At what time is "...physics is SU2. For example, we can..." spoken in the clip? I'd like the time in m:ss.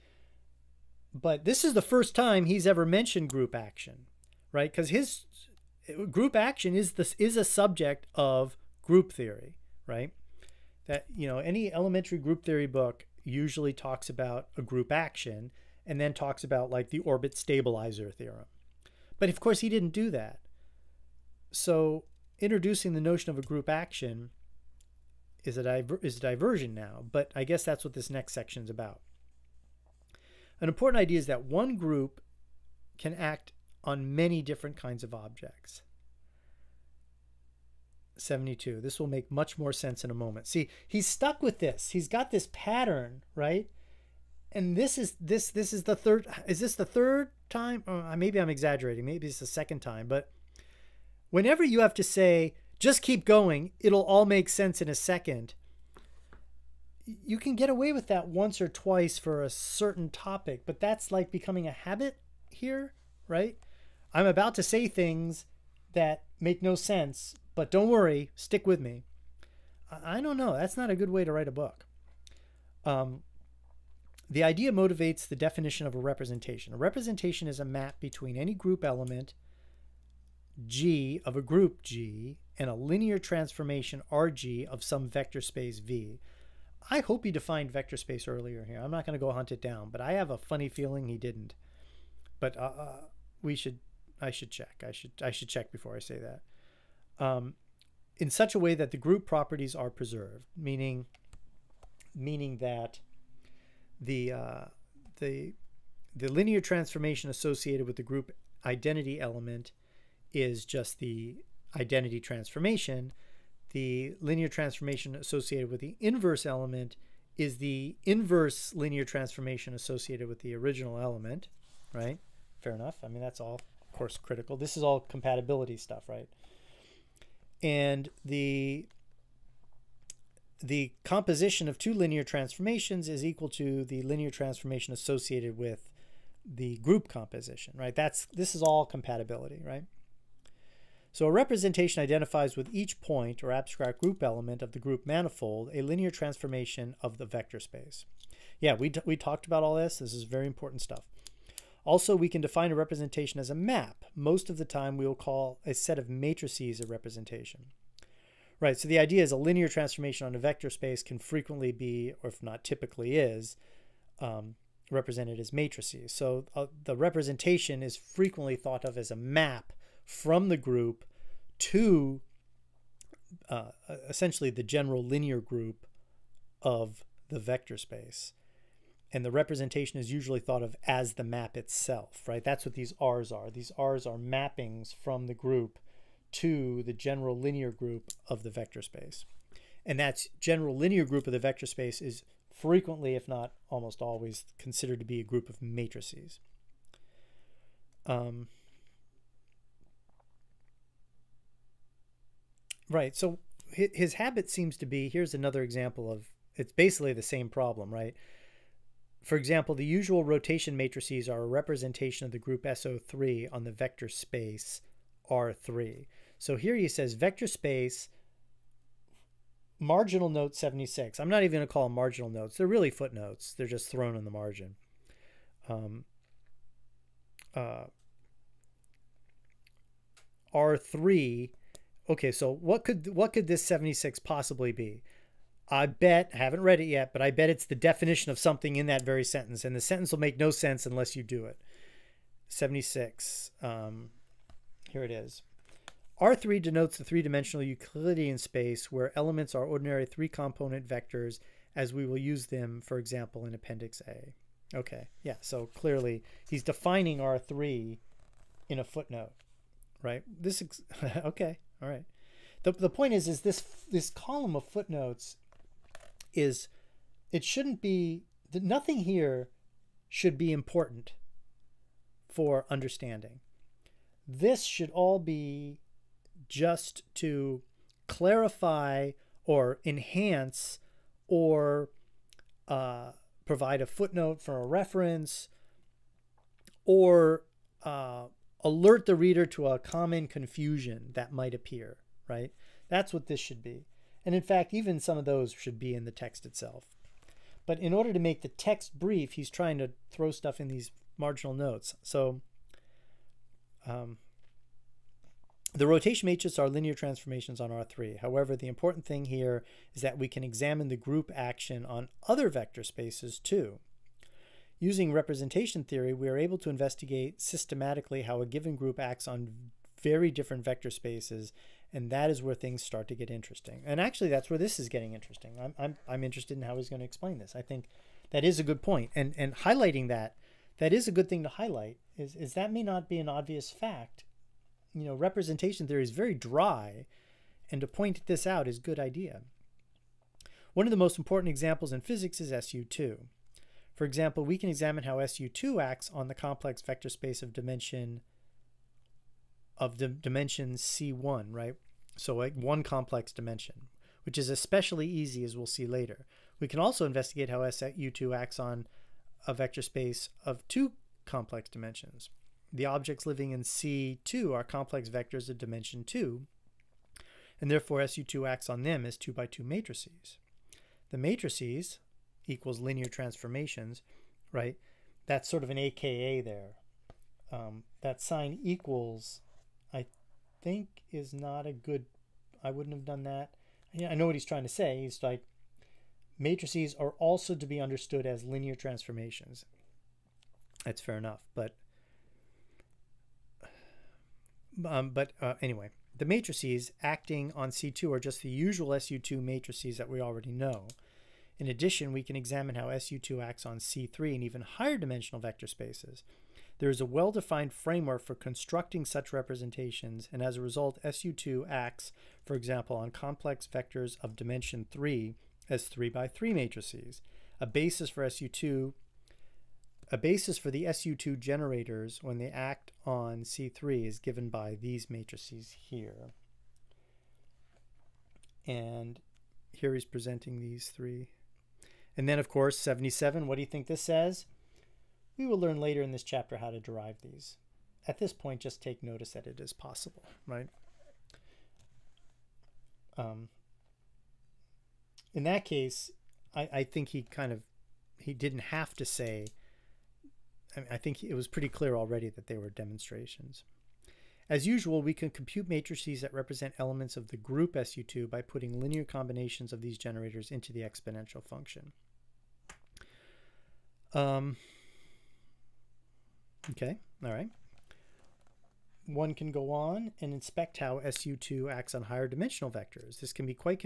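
5:41.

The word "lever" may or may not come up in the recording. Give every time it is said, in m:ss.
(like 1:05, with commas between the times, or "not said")
not said.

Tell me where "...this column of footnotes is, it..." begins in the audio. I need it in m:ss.
4:23.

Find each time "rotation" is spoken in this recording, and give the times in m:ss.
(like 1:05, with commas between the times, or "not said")
3:30, 5:05.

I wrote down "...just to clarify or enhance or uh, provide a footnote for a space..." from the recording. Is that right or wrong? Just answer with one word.
wrong.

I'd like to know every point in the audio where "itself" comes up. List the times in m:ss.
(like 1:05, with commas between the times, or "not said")
3:01, 4:56.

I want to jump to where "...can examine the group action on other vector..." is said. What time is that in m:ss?
5:10.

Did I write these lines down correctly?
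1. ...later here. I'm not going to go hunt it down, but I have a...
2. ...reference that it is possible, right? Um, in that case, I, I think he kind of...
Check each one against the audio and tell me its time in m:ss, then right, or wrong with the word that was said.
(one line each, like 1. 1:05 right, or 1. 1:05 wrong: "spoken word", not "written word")
1. 1:28 wrong: "earlier", not "later"
2. 7:19 wrong: "notice", not "reference".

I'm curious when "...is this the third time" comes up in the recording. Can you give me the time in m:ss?
0:46.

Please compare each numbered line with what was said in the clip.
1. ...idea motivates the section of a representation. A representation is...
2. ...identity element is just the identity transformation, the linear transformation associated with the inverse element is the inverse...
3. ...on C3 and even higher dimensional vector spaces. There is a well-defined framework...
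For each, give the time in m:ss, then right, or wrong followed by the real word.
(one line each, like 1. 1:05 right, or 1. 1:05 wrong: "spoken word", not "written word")
1. 1:14 wrong: "definition", not "section"
2. 1:48 right
3. 6:43 right.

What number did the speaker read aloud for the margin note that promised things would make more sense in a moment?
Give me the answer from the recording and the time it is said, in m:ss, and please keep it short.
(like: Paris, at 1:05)
72, at 0:38.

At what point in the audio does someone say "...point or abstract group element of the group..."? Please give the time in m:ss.
2:22.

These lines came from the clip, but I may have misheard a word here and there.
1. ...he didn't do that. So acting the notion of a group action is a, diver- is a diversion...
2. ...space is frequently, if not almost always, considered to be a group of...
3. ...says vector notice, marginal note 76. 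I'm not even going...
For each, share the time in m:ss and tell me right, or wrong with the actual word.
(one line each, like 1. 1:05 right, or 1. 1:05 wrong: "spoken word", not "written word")
1. 0:19 wrong: "introducing", not "acting"
2. 3:11 right
3. 3:36 wrong: "space", not "notice".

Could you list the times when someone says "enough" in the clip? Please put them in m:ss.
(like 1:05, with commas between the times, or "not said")
2:02, 6:31.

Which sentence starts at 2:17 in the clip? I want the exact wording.
That's this is all compatibility, right?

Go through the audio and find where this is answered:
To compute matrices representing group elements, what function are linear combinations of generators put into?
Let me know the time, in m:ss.
7:40.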